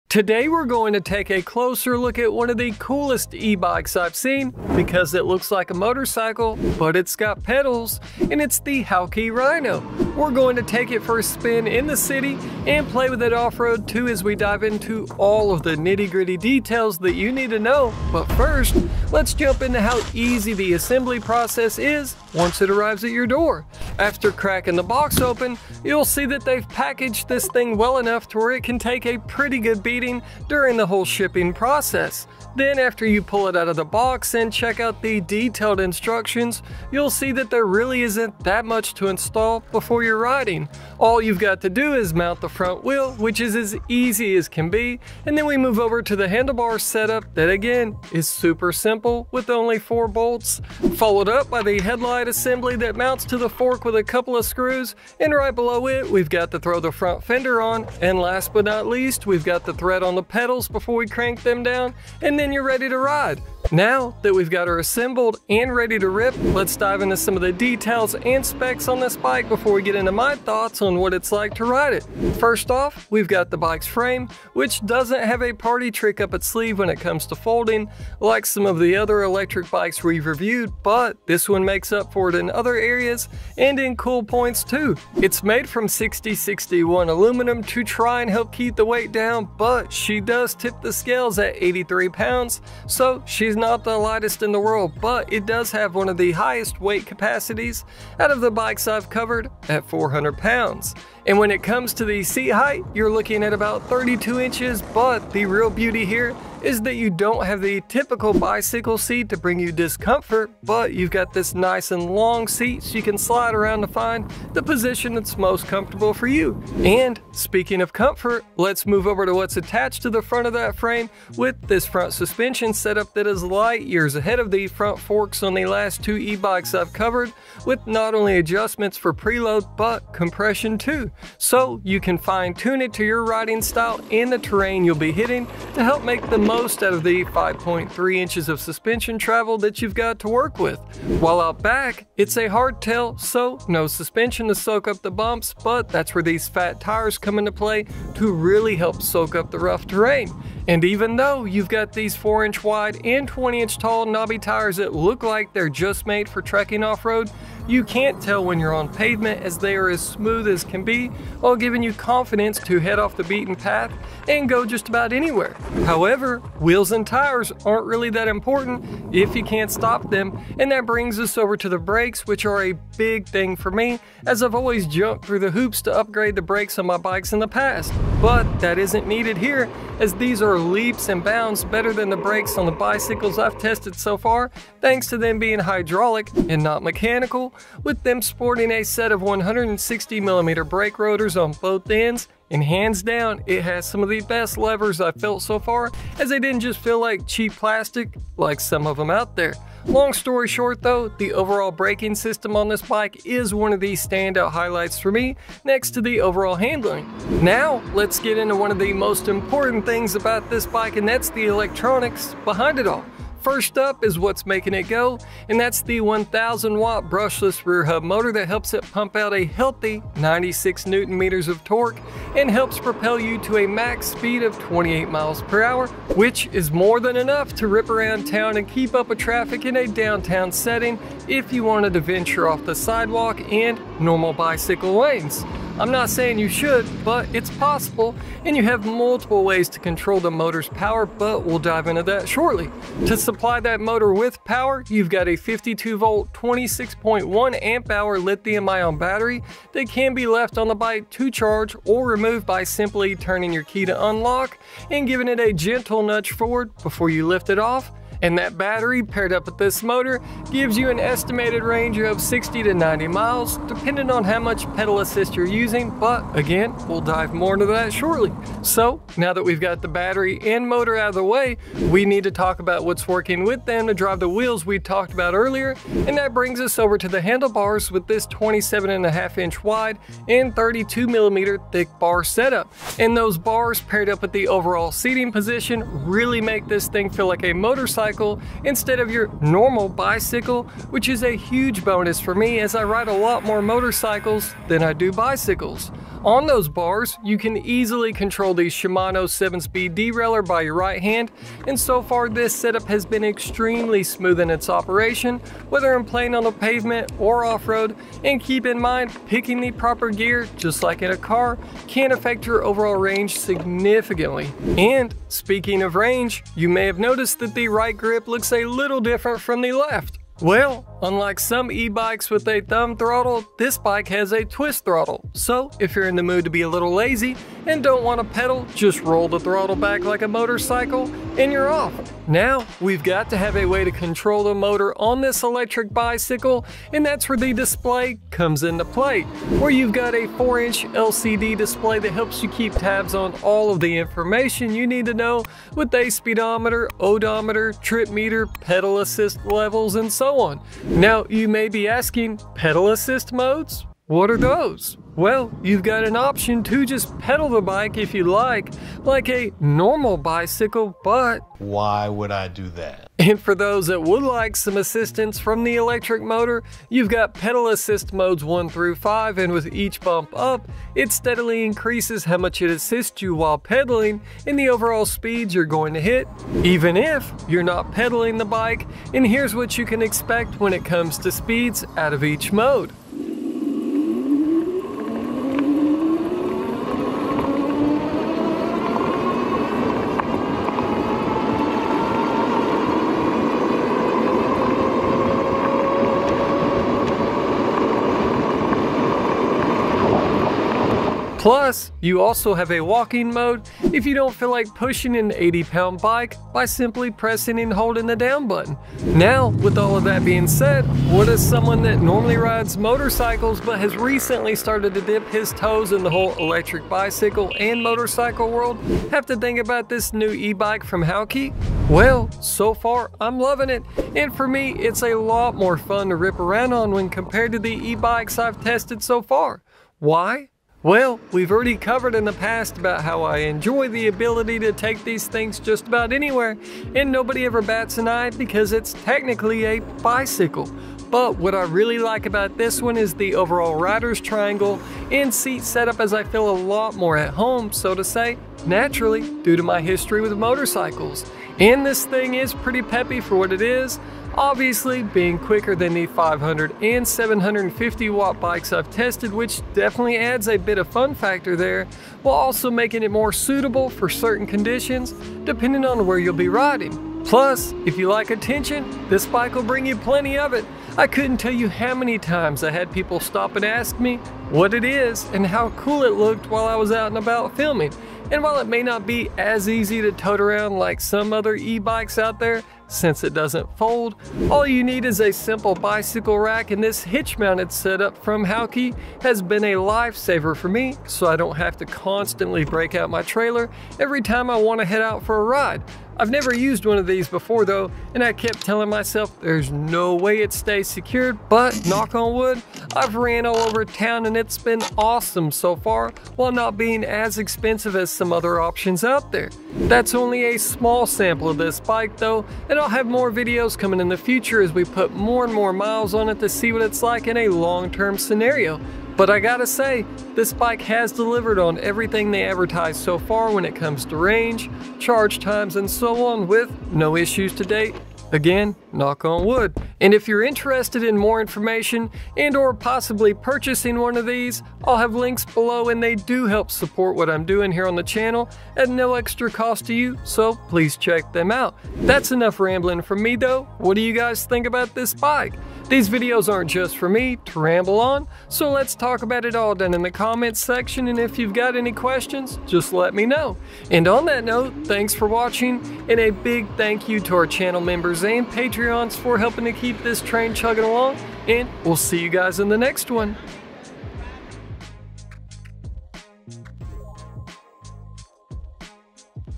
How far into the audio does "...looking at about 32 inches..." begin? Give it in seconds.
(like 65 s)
103 s.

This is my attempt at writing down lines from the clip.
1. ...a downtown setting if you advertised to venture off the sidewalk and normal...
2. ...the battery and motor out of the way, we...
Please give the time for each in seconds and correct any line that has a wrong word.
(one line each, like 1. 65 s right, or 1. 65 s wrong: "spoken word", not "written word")
1. 229 s wrong: "wanted", not "advertised"
2. 269 s right.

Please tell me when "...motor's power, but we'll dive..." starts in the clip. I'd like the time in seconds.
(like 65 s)
240 s.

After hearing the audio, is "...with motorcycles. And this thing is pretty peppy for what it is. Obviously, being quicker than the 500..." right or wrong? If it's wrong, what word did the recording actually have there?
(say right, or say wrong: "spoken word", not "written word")
right.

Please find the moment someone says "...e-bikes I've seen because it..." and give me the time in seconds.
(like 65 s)
3 s.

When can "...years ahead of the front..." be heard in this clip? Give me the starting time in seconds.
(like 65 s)
123 s.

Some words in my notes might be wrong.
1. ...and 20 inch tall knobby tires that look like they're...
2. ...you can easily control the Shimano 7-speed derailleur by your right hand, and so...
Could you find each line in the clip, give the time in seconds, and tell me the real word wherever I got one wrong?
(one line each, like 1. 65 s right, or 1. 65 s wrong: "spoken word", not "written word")
1. 153 s right
2. 297 s right.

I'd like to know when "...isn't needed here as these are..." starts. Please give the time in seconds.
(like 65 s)
178 s.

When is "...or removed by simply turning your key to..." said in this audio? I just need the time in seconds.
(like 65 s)
251 s.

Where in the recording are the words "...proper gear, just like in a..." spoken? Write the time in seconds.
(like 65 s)
309 s.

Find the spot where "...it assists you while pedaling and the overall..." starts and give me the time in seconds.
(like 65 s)
372 s.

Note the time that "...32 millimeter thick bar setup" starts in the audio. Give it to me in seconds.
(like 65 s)
280 s.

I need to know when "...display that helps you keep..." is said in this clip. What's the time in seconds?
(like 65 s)
341 s.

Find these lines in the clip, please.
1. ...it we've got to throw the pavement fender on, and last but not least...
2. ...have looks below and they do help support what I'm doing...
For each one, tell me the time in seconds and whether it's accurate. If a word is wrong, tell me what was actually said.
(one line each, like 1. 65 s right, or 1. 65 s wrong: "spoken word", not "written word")
1. 55 s wrong: "front", not "pavement"
2. 534 s wrong: "links", not "looks".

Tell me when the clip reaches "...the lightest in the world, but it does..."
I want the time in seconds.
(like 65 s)
93 s.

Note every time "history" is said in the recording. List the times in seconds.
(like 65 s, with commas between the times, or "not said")
449 s.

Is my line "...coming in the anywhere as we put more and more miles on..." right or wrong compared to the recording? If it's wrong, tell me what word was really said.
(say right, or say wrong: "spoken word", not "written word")
wrong: "future", not "anywhere".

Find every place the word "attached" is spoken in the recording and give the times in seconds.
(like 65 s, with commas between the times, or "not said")
119 s.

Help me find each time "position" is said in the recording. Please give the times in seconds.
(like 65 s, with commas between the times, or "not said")
114 s, 285 s.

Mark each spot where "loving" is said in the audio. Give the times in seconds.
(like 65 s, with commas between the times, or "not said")
423 s.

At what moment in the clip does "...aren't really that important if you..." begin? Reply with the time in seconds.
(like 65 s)
167 s.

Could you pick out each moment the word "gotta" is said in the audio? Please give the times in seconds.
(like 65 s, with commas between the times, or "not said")
519 s.